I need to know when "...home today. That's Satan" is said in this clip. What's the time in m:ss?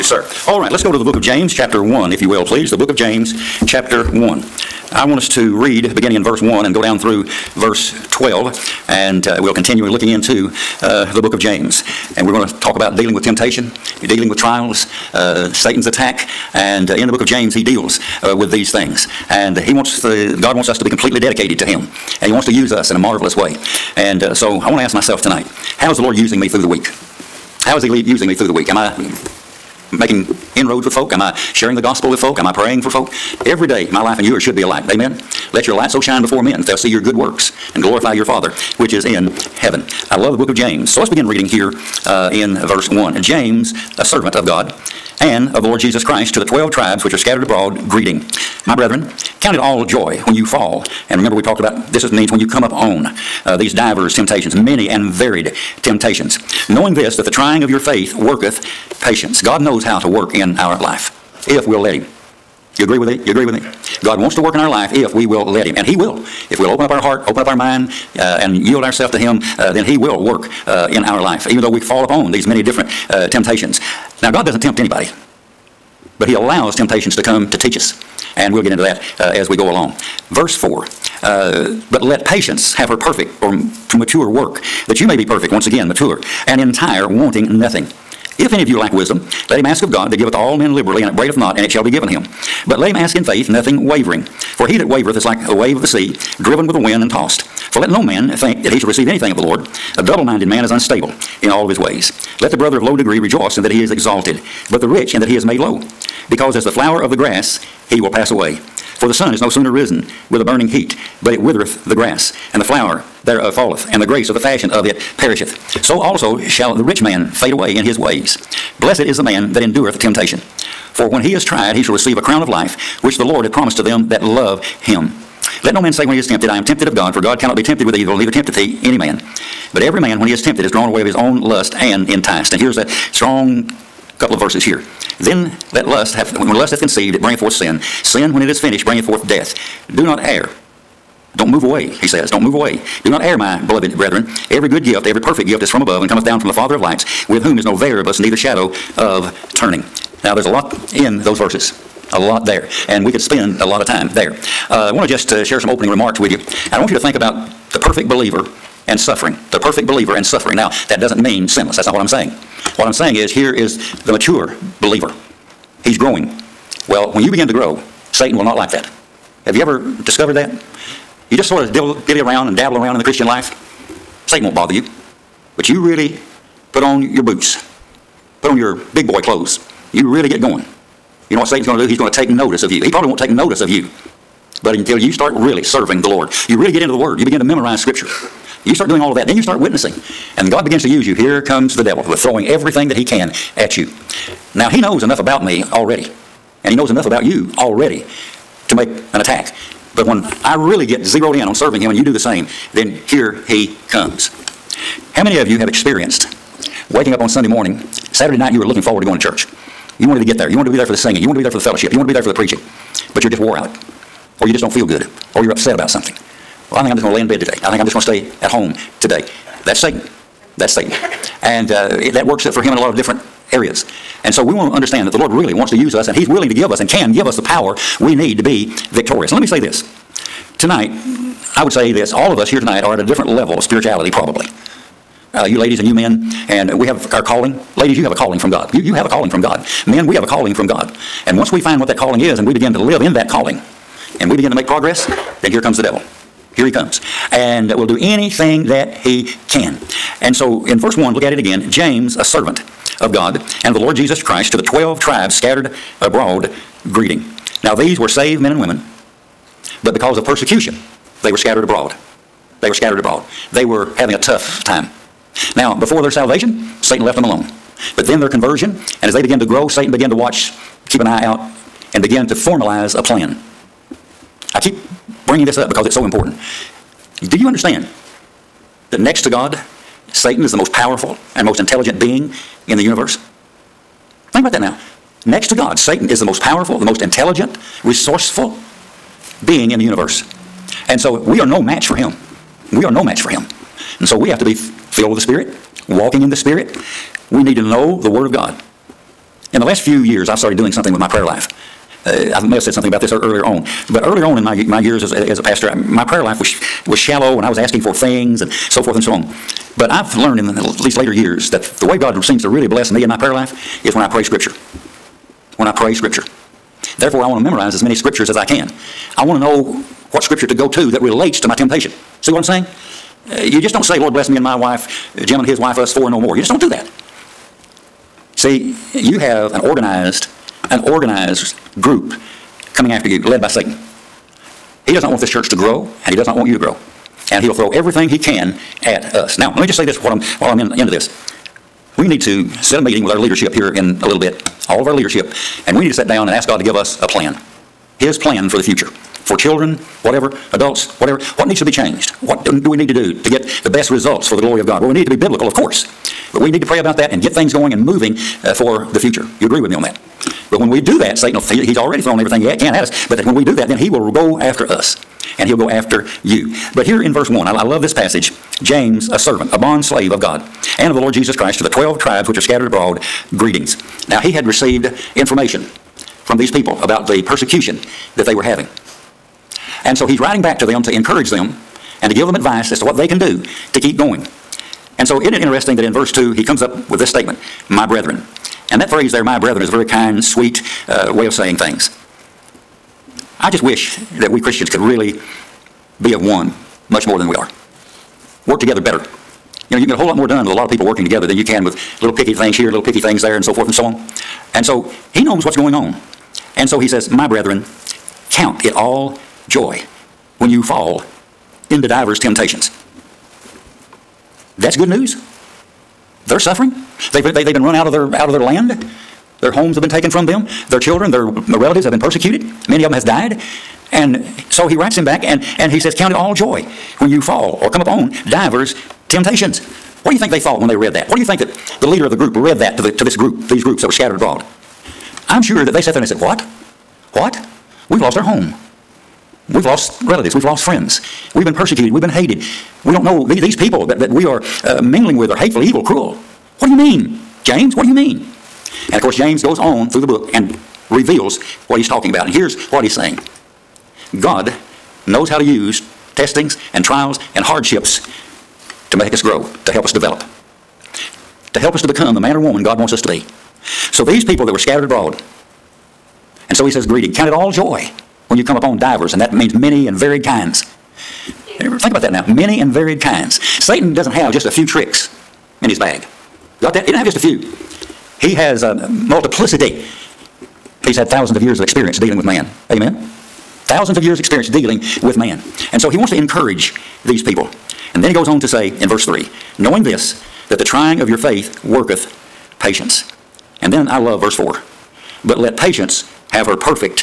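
3:38.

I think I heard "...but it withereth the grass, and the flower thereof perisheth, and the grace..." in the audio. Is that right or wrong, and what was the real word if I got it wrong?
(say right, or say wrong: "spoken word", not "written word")
wrong: "falleth", not "perisheth".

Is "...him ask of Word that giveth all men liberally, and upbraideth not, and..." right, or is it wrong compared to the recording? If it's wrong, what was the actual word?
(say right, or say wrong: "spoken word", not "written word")
wrong: "God", not "Word".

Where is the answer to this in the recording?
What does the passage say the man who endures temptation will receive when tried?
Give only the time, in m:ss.
2:02.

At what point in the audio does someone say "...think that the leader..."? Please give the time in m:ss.
7:11.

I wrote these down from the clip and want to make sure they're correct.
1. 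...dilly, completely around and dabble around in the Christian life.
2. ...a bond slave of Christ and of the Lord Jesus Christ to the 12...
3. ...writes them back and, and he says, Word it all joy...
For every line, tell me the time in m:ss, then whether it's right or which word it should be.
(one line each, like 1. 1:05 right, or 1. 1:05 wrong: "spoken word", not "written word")
1. 2:51 wrong: "dilly", not "completely"
2. 6:09 wrong: "God", not "Christ"
3. 7:04 wrong: "Count", not "Word".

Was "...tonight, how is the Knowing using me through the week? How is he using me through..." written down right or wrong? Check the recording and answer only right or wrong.
wrong.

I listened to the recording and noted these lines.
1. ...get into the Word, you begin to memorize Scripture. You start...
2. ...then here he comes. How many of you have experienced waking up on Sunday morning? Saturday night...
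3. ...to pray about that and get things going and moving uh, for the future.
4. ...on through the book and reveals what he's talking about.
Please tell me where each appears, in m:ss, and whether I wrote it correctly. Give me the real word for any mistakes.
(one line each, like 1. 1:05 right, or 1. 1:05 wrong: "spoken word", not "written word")
1. 3:06 right
2. 3:22 right
3. 5:56 right
4. 7:29 right.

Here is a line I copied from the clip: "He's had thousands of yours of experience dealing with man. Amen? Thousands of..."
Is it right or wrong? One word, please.
wrong.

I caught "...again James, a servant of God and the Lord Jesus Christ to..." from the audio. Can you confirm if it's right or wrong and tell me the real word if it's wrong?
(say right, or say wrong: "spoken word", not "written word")
right.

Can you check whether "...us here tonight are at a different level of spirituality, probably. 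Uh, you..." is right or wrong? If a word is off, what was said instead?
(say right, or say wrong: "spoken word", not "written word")
right.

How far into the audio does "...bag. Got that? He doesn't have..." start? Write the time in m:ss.
7:55.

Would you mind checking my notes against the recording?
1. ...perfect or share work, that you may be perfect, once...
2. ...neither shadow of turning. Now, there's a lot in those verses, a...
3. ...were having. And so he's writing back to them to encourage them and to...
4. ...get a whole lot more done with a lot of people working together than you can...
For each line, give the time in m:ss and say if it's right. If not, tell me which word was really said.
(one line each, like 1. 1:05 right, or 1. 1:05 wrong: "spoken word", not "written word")
1. 1:22 wrong: "mature", not "share"
2. 2:28 right
3. 6:18 right
4. 6:39 right.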